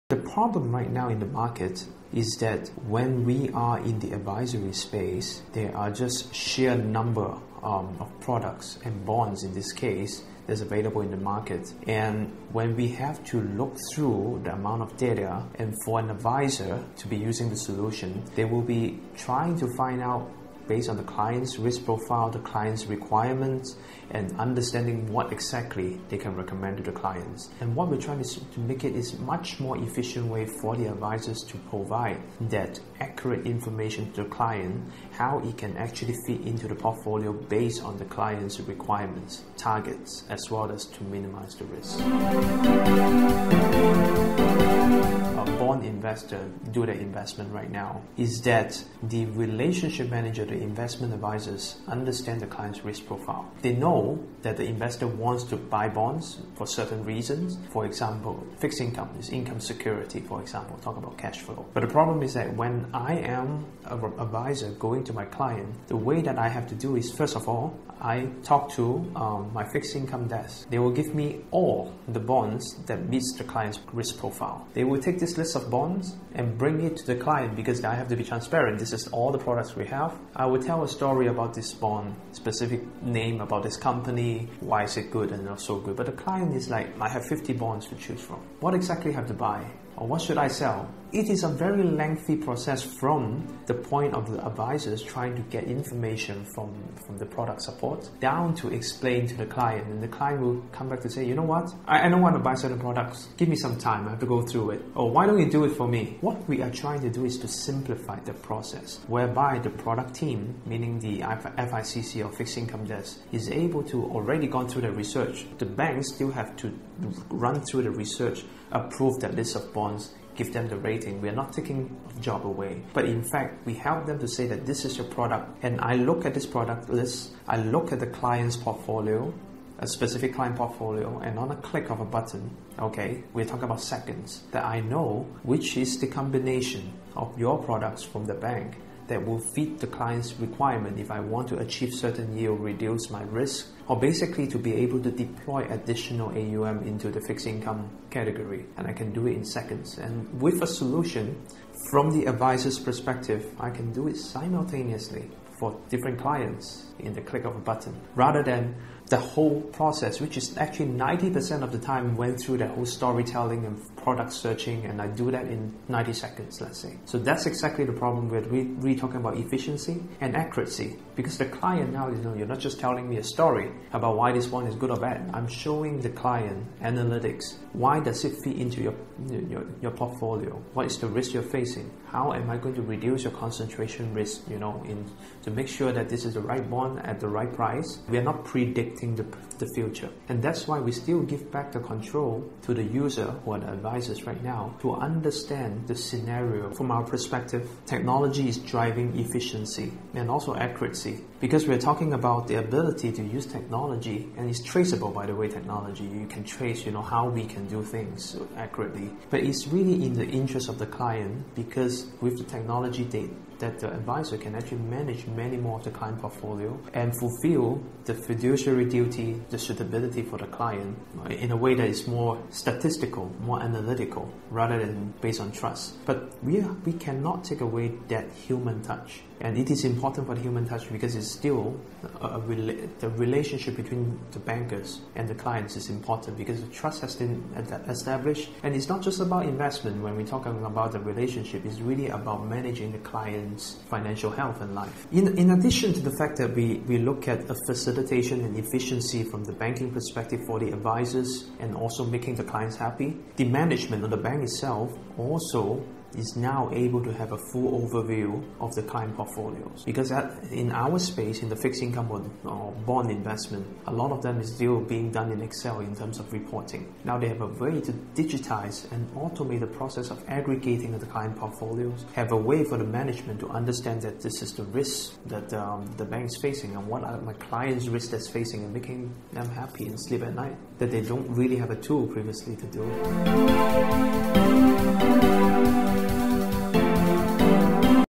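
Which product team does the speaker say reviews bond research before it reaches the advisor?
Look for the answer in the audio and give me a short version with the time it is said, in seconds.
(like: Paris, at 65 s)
FICC, at 111 s.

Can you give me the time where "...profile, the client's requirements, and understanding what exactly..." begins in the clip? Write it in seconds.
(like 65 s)
21 s.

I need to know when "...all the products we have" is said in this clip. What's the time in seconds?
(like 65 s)
79 s.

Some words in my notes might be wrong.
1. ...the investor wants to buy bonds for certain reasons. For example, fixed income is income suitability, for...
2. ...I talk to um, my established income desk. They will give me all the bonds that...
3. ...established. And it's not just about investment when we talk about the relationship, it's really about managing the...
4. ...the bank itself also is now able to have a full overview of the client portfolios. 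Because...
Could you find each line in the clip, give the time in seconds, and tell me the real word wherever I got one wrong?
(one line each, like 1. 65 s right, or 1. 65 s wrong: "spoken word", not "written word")
1. 54 s wrong: "security", not "suitability"
2. 68 s wrong: "fixed", not "established"
3. 237 s right
4. 254 s right.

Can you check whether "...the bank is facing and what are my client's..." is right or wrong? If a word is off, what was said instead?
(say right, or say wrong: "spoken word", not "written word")
right.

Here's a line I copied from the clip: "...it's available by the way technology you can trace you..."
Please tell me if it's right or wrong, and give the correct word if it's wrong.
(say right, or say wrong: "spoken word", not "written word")
wrong: "traceable", not "available".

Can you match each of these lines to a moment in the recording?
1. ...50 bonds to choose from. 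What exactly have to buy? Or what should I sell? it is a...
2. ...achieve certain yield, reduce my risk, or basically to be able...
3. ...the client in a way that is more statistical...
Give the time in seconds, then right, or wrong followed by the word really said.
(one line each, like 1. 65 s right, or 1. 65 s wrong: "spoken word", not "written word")
1. 87 s right
2. 141 s right
3. 220 s right.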